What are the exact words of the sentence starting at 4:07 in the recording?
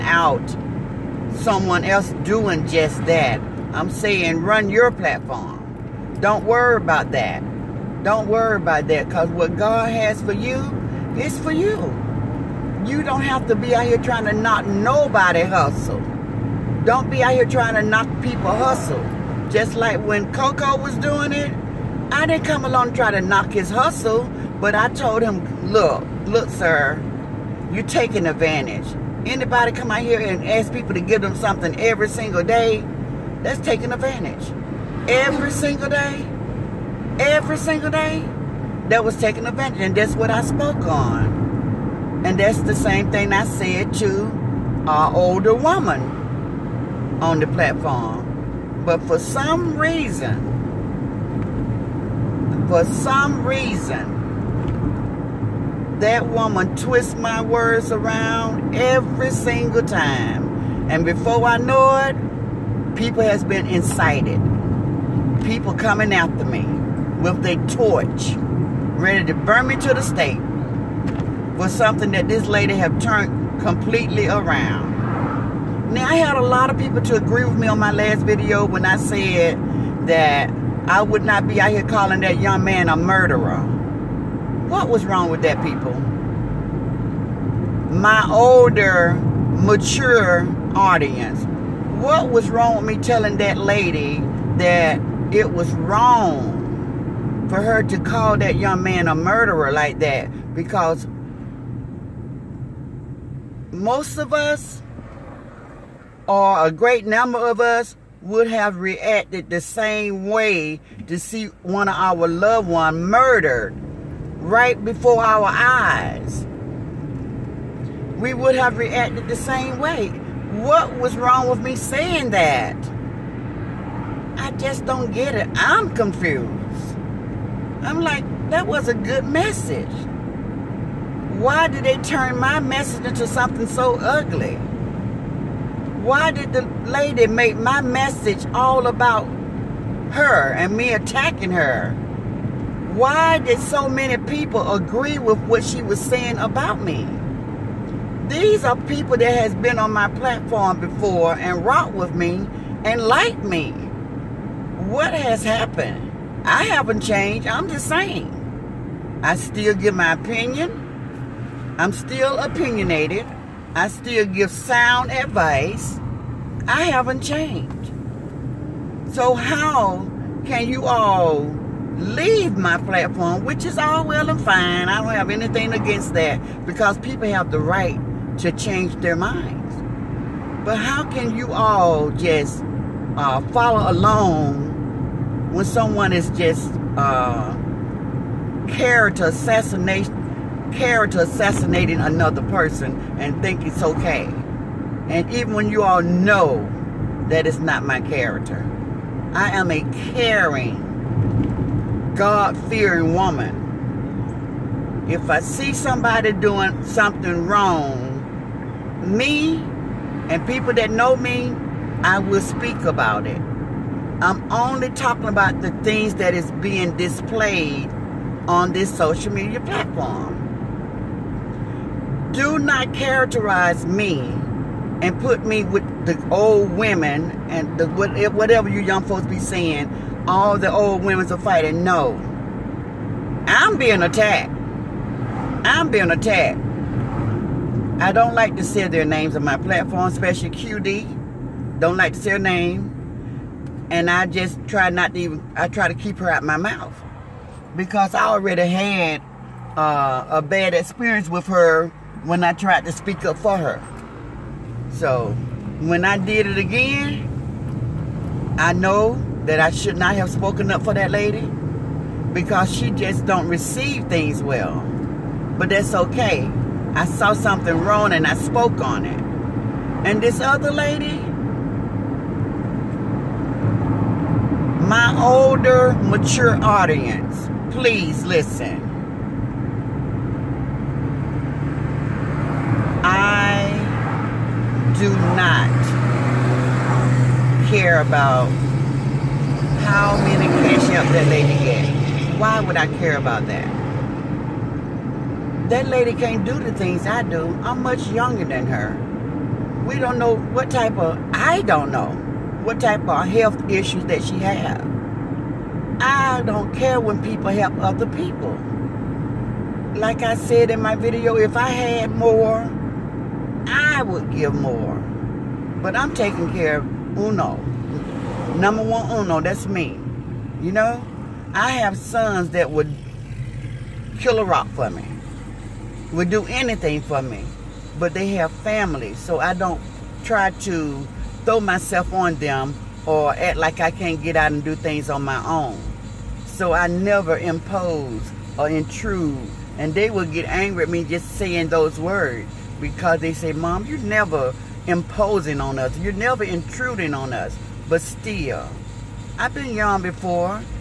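Because I already had uh, a bad experience with her when I tried to speak up for her.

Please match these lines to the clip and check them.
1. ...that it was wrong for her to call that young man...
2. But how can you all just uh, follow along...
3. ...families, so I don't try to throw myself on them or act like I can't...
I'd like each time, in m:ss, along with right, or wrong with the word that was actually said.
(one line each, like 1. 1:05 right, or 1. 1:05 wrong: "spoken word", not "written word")
1. 1:34 right
2. 3:00 right
3. 5:28 right.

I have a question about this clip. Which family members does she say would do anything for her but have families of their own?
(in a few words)
sons.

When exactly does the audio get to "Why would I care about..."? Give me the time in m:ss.
4:52.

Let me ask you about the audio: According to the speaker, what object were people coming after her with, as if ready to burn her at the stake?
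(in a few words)
torch.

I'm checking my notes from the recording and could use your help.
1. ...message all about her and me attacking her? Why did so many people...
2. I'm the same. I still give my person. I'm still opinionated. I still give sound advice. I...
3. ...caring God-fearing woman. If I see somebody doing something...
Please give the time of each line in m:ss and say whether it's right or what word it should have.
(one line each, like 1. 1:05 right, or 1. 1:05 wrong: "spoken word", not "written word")
1. 2:17 right
2. 2:37 wrong: "opinion", not "person"
3. 3:20 right.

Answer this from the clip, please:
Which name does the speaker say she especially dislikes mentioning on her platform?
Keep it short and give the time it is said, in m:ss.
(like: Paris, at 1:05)
QD, at 4:00.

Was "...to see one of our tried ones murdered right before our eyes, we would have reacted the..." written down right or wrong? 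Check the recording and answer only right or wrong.
wrong.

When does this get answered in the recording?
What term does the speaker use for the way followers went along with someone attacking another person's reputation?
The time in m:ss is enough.
3:08.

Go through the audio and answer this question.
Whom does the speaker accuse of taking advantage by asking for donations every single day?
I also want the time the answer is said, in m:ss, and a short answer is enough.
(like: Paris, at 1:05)
Coco, at 0:20.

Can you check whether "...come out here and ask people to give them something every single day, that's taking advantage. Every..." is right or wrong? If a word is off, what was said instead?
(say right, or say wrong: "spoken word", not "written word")
right.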